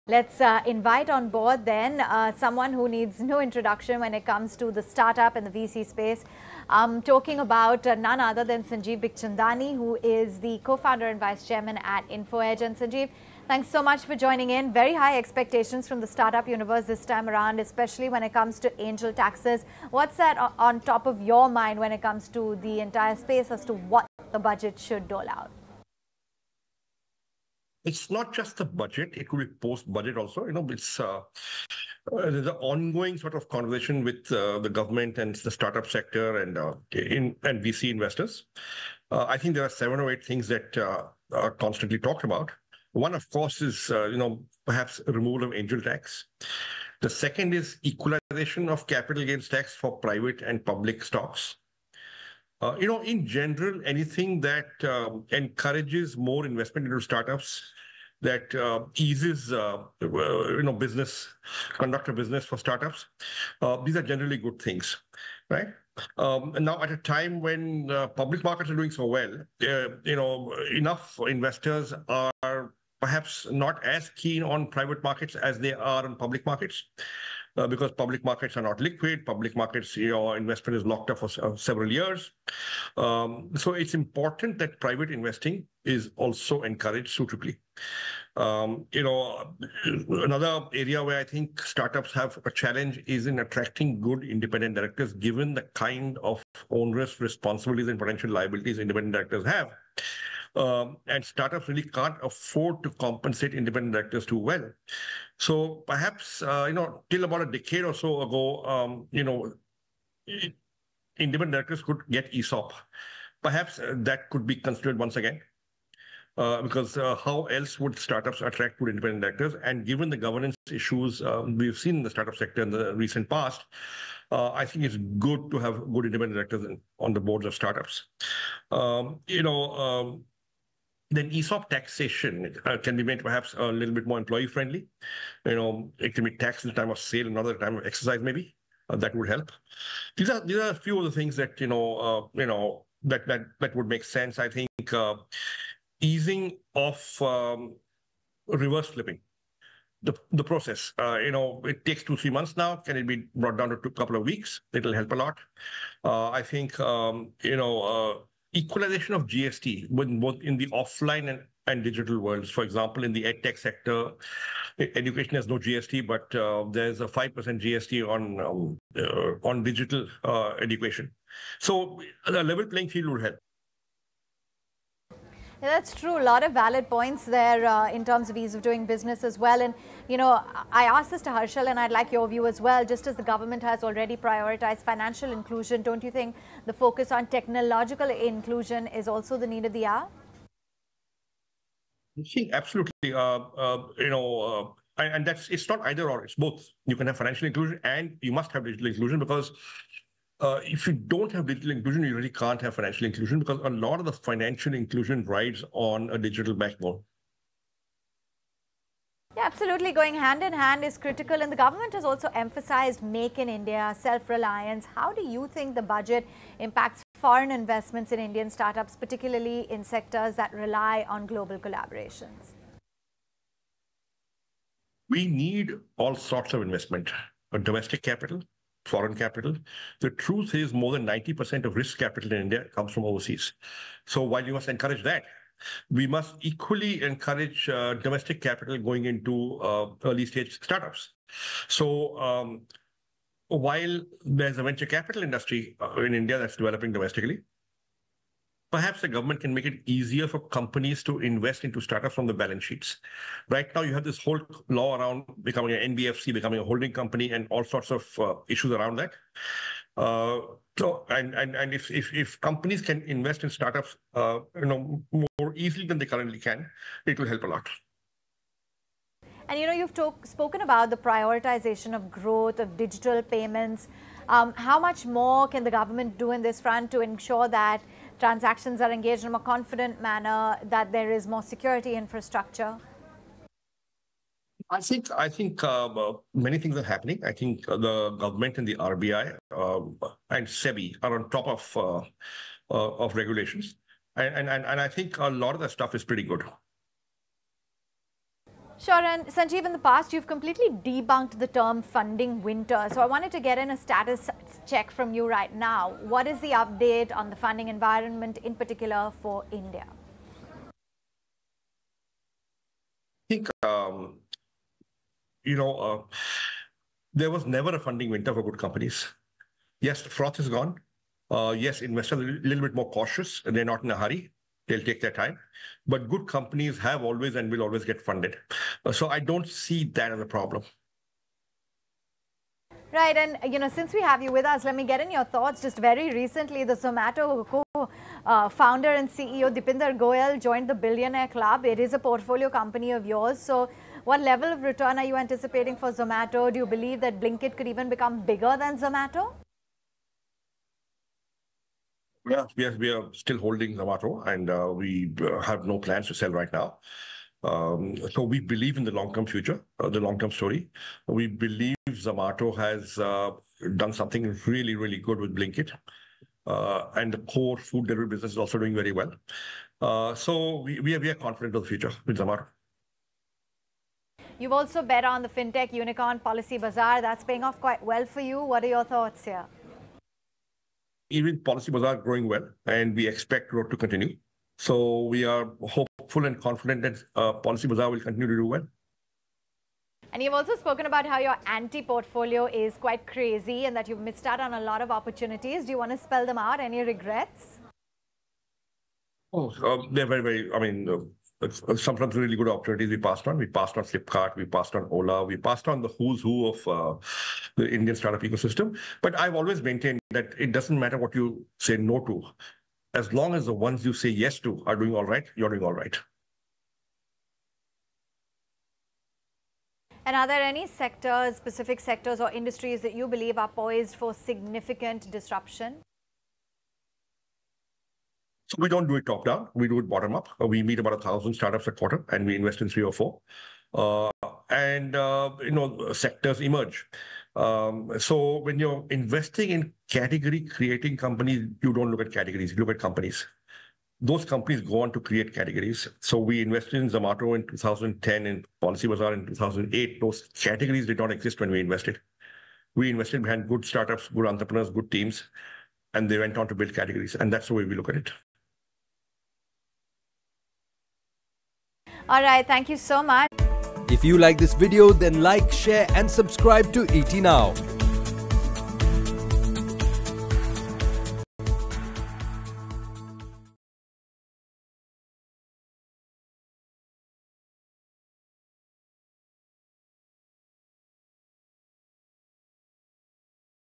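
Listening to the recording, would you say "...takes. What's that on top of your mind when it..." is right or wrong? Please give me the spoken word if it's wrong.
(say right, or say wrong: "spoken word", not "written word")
wrong: "taxes", not "takes".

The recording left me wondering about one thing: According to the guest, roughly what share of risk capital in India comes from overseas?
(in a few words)
More than 90%.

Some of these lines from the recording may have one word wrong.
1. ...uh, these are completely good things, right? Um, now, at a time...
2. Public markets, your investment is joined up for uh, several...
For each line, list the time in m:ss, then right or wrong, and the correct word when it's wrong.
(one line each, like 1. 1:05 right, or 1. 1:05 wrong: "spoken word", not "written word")
1. 1:03 wrong: "generally", not "completely"
2. 1:19 wrong: "locked", not "joined".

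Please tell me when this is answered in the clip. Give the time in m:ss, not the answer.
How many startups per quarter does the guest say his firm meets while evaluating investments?
7:10.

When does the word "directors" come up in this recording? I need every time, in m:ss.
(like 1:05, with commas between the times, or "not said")
1:34, 1:39, 1:43, 1:51, 1:59, 2:06.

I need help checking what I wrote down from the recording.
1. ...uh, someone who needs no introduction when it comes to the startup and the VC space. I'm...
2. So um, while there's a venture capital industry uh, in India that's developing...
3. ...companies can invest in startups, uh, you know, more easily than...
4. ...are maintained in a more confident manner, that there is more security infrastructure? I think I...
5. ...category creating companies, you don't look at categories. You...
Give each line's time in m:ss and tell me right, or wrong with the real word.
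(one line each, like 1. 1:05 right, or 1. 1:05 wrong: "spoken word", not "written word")
1. 0:02 right
2. 4:01 right
3. 4:22 right
4. 4:38 wrong: "engaged", not "maintained"
5. 7:19 right.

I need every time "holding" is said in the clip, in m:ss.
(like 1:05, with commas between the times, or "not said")
4:16, 5:53.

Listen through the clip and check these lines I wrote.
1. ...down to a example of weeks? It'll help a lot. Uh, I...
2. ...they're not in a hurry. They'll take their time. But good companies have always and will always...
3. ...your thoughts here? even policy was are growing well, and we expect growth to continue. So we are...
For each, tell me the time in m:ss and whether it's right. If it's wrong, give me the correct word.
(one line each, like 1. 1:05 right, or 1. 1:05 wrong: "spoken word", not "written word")
1. 2:33 wrong: "couple", not "example"
2. 5:23 right
3. 6:18 right.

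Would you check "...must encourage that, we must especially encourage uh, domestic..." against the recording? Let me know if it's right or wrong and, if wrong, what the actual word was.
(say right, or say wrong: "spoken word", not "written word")
wrong: "equally", not "especially".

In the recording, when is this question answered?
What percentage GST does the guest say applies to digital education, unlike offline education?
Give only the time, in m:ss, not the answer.
2:47.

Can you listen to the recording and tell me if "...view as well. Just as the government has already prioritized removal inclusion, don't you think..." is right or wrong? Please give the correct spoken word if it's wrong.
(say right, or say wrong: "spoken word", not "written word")
wrong: "financial", not "removal".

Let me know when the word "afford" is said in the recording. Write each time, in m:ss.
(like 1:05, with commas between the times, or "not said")
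1:42.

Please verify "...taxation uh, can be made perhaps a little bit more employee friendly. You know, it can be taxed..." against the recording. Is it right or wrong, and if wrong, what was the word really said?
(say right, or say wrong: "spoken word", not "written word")
right.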